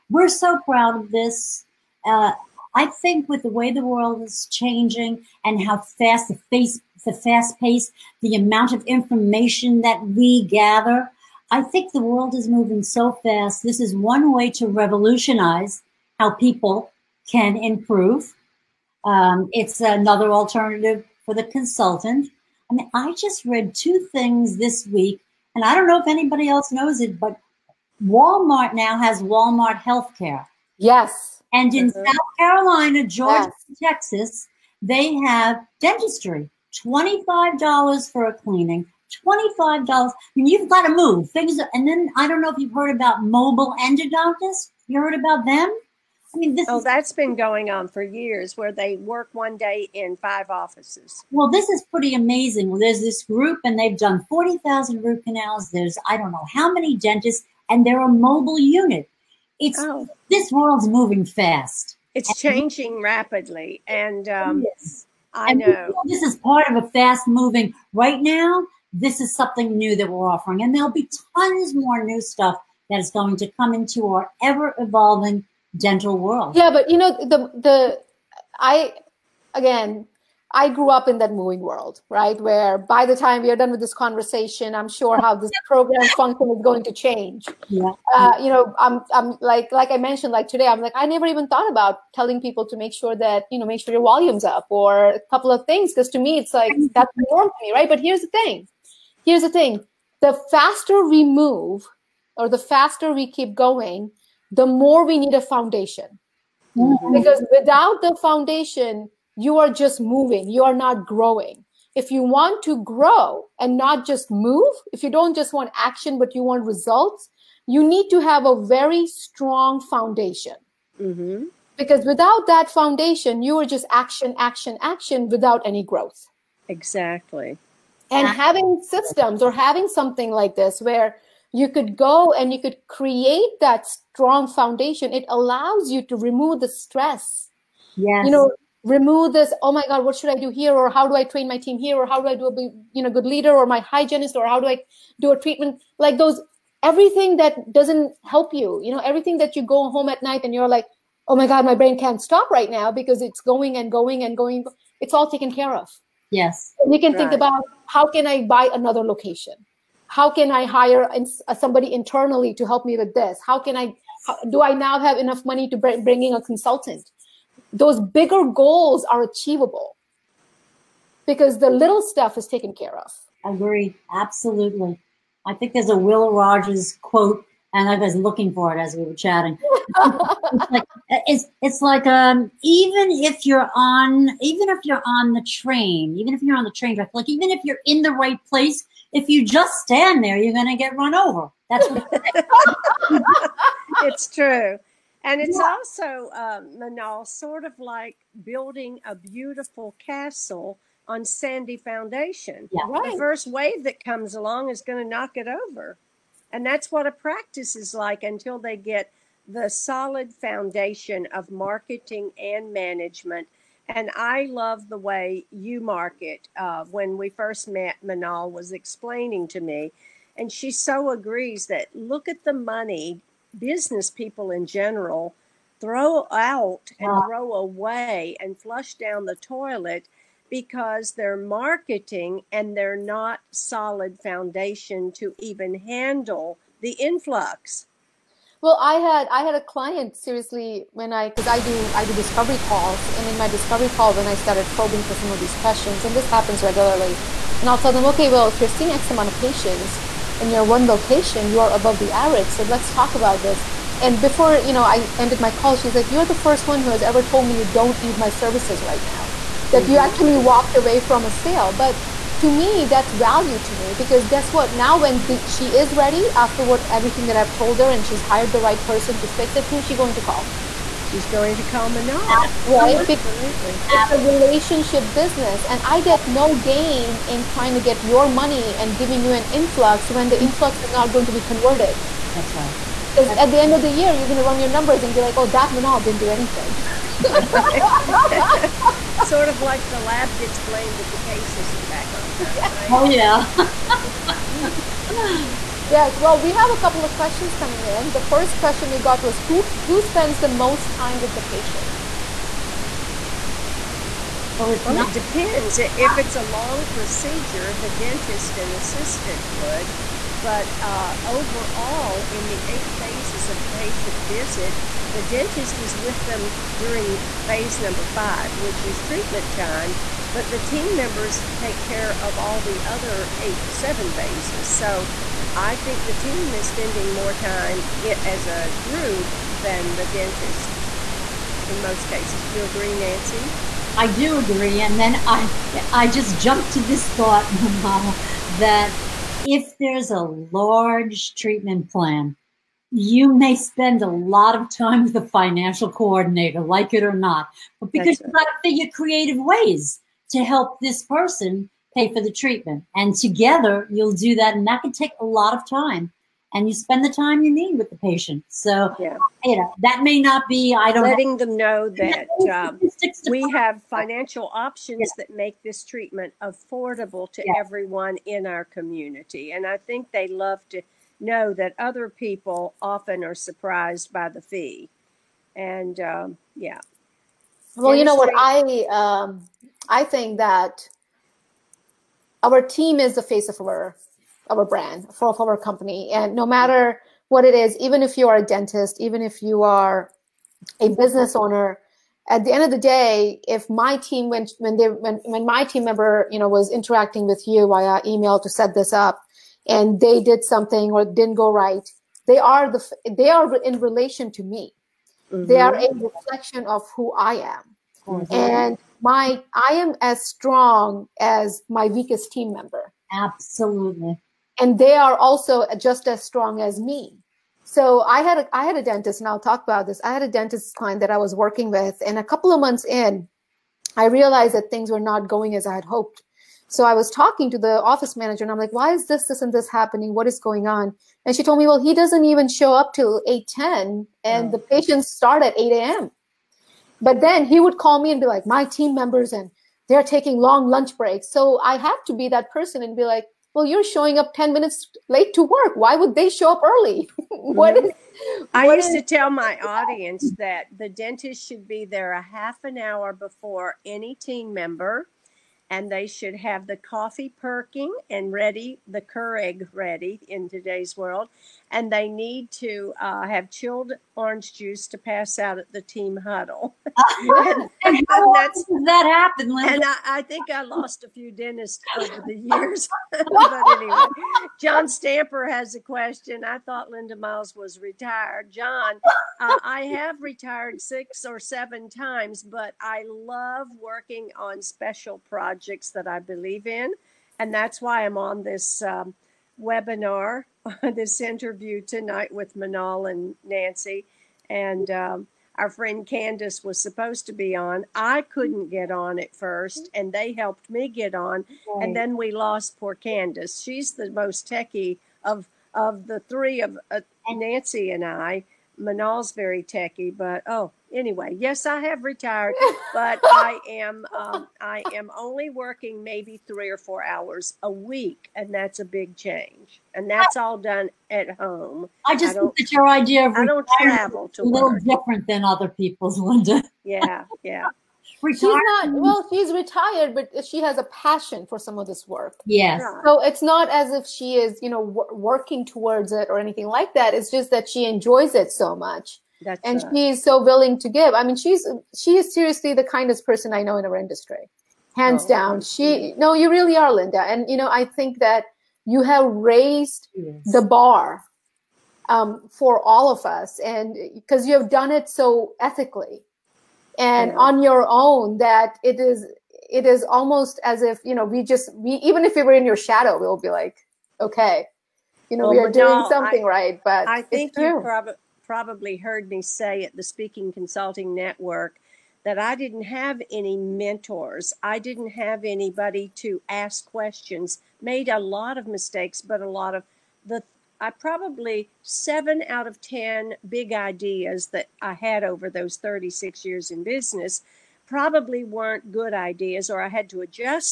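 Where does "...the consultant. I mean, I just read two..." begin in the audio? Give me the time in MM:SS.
00:21.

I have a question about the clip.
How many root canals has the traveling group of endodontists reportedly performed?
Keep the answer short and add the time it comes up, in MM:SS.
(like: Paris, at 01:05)
40,000, at 00:54.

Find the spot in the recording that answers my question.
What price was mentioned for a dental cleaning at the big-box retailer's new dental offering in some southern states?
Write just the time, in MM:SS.
00:36.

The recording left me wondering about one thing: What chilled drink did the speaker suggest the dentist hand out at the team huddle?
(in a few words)
orange juice.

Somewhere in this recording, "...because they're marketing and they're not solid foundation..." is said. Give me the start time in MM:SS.
03:50.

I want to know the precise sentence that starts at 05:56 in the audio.
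And you spend the time you need with the patient.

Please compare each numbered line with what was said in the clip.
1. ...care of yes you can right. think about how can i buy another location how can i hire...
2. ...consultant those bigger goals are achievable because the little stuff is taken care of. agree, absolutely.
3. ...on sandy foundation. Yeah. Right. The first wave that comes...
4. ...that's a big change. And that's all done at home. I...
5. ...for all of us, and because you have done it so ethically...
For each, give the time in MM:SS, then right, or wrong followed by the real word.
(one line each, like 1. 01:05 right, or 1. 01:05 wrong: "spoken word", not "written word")
1. 02:35 right
2. 02:46 right
3. 03:21 right
4. 08:38 right
5. 09:12 right.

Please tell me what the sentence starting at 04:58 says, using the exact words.
The first question we got was who who spends the most time with the patient?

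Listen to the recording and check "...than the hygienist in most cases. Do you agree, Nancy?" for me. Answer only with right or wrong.
wrong.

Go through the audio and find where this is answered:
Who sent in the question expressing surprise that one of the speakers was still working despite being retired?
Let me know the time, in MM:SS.
07:54.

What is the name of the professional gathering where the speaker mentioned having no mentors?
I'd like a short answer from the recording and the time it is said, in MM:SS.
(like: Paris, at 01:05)
Speaking Consulting Network, at 09:30.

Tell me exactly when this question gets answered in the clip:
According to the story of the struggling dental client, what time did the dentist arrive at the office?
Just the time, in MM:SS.
07:13.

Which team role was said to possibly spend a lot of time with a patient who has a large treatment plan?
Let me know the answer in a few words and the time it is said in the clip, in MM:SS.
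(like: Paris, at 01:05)
financial coordinator, at 05:45.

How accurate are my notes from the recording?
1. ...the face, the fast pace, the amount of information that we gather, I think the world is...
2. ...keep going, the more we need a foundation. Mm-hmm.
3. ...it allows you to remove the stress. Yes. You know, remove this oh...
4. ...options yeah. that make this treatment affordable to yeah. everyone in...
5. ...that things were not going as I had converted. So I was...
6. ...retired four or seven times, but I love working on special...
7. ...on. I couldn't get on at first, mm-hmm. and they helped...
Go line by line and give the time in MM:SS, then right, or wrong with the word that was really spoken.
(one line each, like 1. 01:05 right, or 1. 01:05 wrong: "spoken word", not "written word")
1. 00:06 right
2. 01:43 right
3. 02:15 right
4. 06:04 right
5. 07:04 wrong: "hoped", not "converted"
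6. 08:00 wrong: "six", not "four"
7. 08:17 right.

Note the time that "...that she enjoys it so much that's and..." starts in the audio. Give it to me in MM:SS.
08:57.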